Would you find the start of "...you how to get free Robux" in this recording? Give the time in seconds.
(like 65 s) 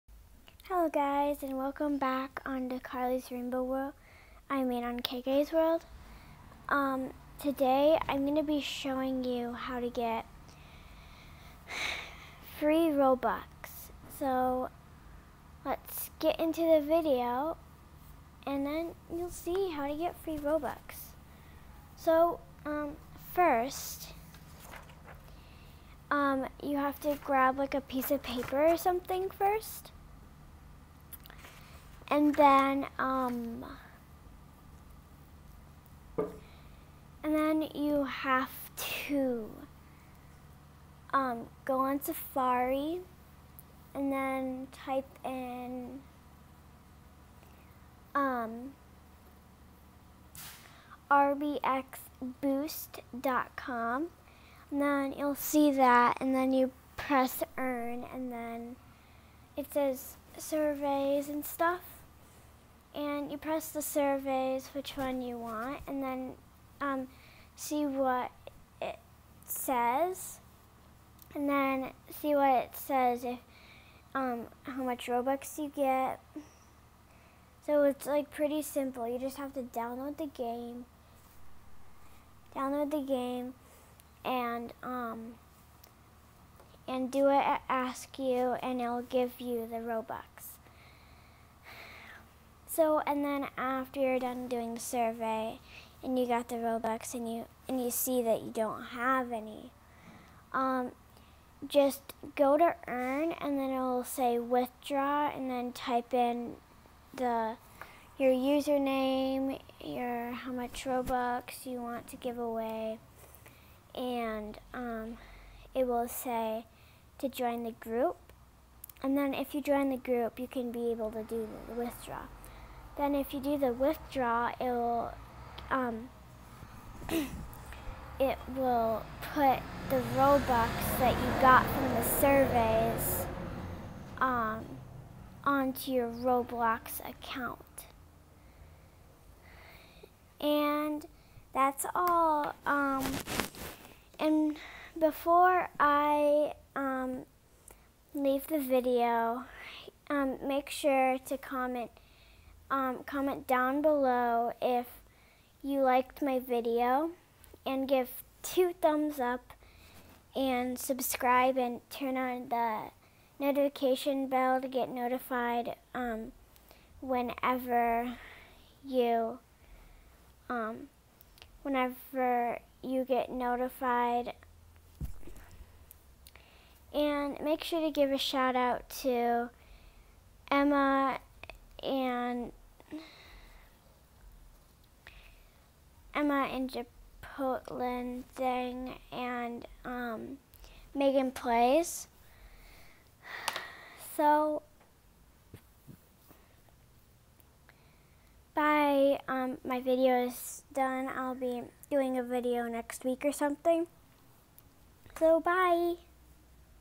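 9 s.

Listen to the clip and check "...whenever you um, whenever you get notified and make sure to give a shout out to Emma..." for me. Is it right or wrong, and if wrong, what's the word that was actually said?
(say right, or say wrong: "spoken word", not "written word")
right.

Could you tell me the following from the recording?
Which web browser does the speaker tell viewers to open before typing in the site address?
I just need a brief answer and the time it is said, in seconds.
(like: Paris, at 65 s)
Safari, at 42 s.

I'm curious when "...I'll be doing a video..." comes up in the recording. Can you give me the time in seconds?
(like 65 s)
201 s.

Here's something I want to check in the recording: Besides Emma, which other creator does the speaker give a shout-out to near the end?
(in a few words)
Megan Plays.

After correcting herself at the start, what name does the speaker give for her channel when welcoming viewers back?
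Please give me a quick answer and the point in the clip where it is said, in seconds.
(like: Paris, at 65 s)
KK's World, at 5 s.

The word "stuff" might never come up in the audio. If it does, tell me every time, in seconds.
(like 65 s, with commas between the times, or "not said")
61 s.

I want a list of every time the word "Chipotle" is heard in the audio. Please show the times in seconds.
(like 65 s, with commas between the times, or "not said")
186 s.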